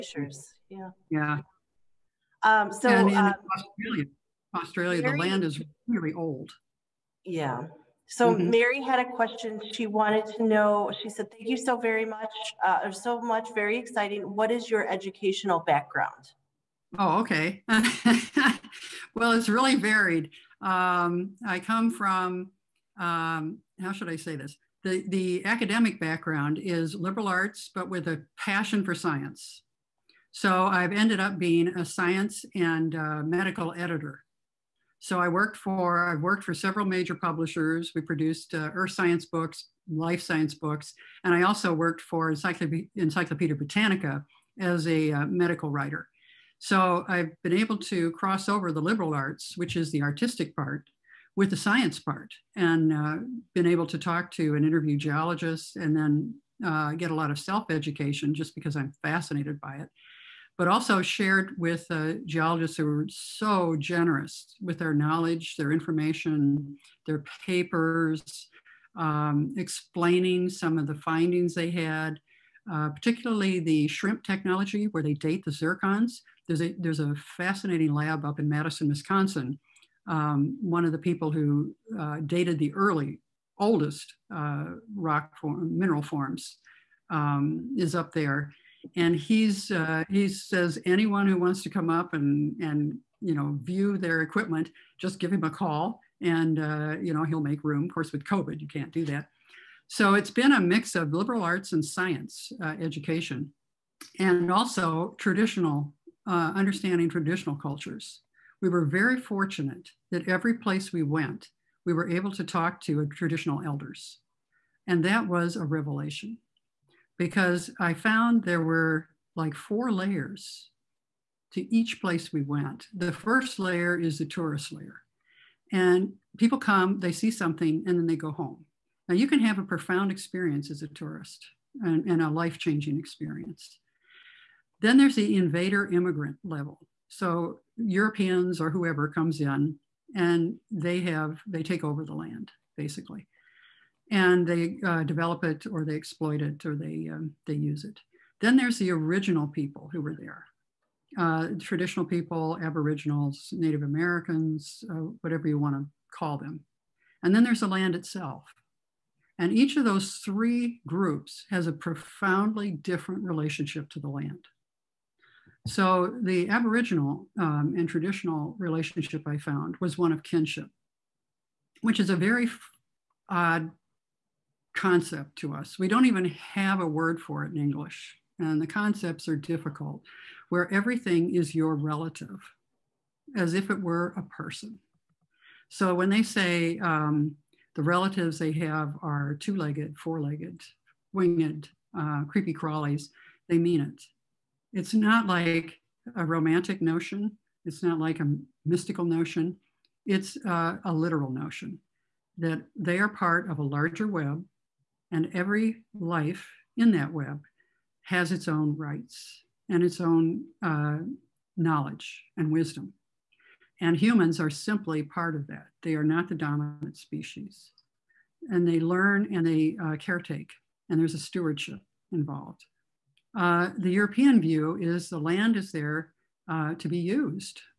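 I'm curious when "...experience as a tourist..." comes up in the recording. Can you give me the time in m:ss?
2:10.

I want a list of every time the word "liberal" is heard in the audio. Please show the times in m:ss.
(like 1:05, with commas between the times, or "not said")
0:26, 0:48, 1:41.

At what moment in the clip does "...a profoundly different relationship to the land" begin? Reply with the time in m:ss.
2:41.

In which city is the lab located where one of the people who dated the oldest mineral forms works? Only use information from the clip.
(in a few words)
Madison, Wisconsin.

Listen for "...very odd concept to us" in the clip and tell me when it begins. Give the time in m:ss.
2:52.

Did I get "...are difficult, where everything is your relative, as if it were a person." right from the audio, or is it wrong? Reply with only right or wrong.
right.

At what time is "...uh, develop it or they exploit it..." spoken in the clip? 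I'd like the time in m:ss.
2:24.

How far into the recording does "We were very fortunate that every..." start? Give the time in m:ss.
1:48.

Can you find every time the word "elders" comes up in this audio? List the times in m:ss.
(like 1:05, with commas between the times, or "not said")
1:53.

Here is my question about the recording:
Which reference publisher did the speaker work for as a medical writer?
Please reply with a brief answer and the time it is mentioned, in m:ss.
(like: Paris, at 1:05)
Encyclopedia Britannica, at 0:42.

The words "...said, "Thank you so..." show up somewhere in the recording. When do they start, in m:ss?
0:11.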